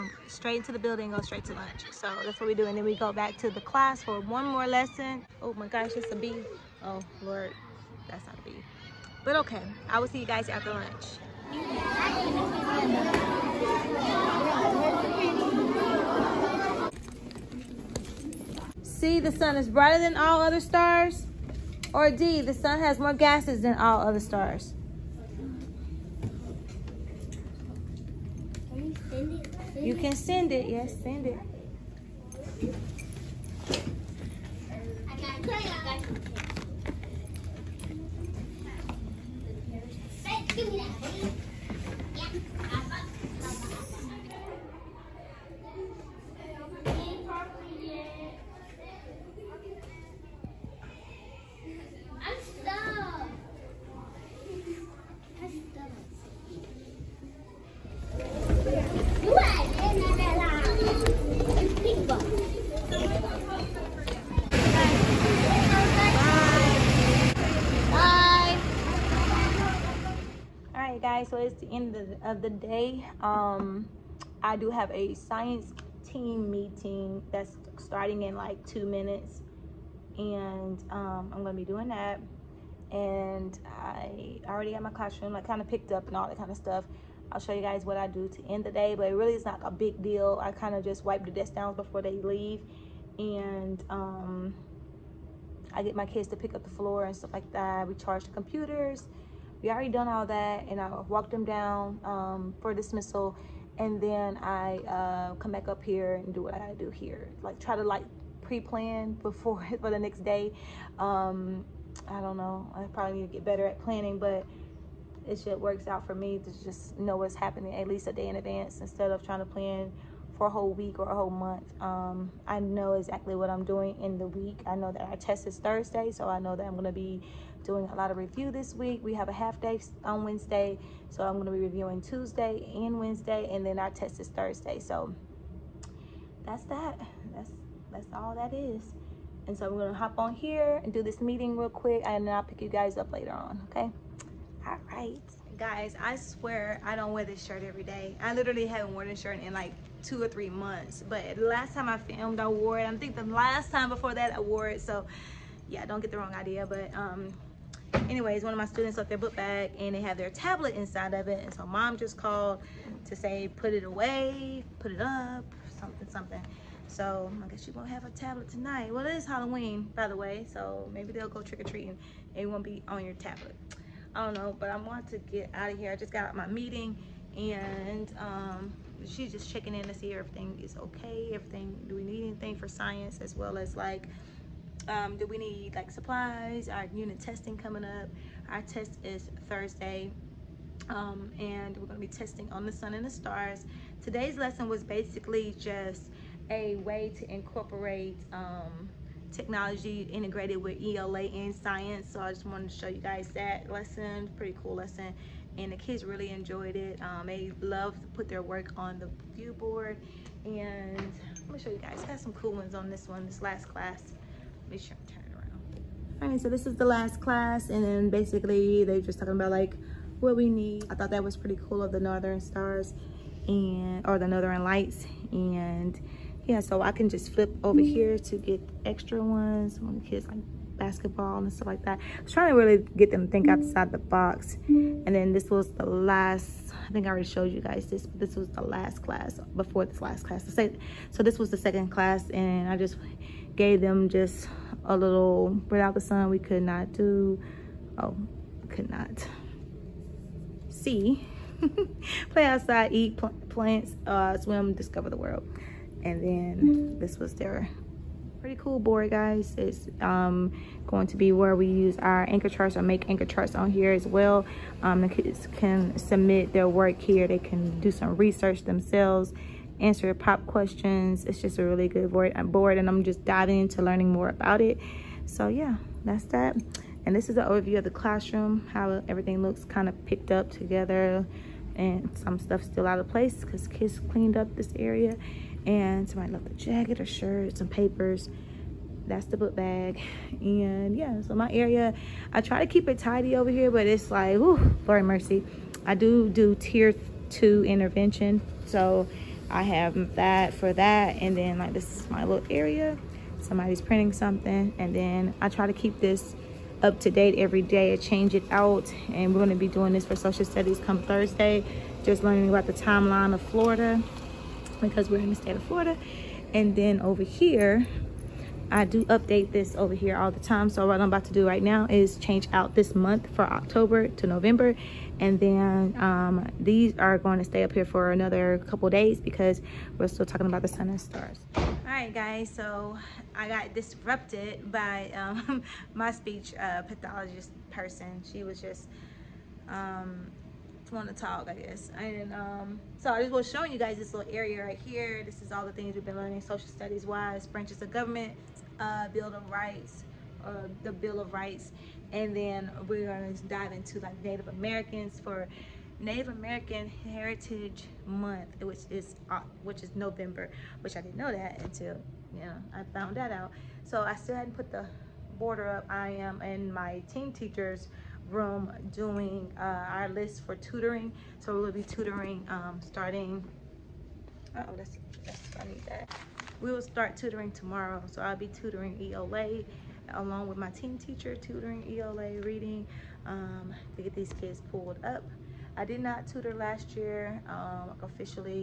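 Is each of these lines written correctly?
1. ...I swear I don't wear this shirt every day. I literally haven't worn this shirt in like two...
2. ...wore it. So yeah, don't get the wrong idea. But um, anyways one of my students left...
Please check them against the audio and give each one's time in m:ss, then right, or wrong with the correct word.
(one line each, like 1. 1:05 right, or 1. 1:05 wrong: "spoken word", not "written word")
1. 2:26 right
2. 2:34 right.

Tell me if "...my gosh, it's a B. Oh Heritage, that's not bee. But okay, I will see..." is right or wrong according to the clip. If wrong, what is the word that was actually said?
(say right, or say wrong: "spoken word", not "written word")
wrong: "Lord", not "Heritage".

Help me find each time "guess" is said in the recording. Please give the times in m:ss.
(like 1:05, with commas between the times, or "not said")
2:47, 5:41.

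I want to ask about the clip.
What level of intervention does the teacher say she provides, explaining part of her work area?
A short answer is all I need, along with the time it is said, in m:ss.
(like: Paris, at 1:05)
Tier two, at 4:56.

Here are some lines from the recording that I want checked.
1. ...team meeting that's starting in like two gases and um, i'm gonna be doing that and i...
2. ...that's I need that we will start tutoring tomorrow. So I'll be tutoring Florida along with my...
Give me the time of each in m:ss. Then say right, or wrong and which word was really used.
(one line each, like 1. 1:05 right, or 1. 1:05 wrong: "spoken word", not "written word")
1. 1:16 wrong: "minutes", not "gases"
2. 6:15 wrong: "ELA", not "Florida".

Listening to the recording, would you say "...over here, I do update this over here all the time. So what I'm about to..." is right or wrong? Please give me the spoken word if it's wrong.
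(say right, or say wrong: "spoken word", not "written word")
right.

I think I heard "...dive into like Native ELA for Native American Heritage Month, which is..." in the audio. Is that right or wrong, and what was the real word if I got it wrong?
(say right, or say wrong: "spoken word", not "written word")
wrong: "Americans", not "ELA".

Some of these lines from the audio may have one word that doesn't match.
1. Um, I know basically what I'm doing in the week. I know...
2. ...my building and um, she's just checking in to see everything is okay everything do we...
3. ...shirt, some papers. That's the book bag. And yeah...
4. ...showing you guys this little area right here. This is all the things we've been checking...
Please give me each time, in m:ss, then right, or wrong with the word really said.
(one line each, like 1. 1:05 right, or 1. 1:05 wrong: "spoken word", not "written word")
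1. 2:01 wrong: "exactly", not "basically"
2. 2:56 wrong: "meeting", not "building"
3. 4:47 right
4. 5:43 wrong: "learning", not "checking".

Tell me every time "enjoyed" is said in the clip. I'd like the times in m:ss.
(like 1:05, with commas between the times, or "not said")
3:26.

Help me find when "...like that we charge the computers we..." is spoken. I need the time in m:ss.
1:37.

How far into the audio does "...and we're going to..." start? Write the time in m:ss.
3:11.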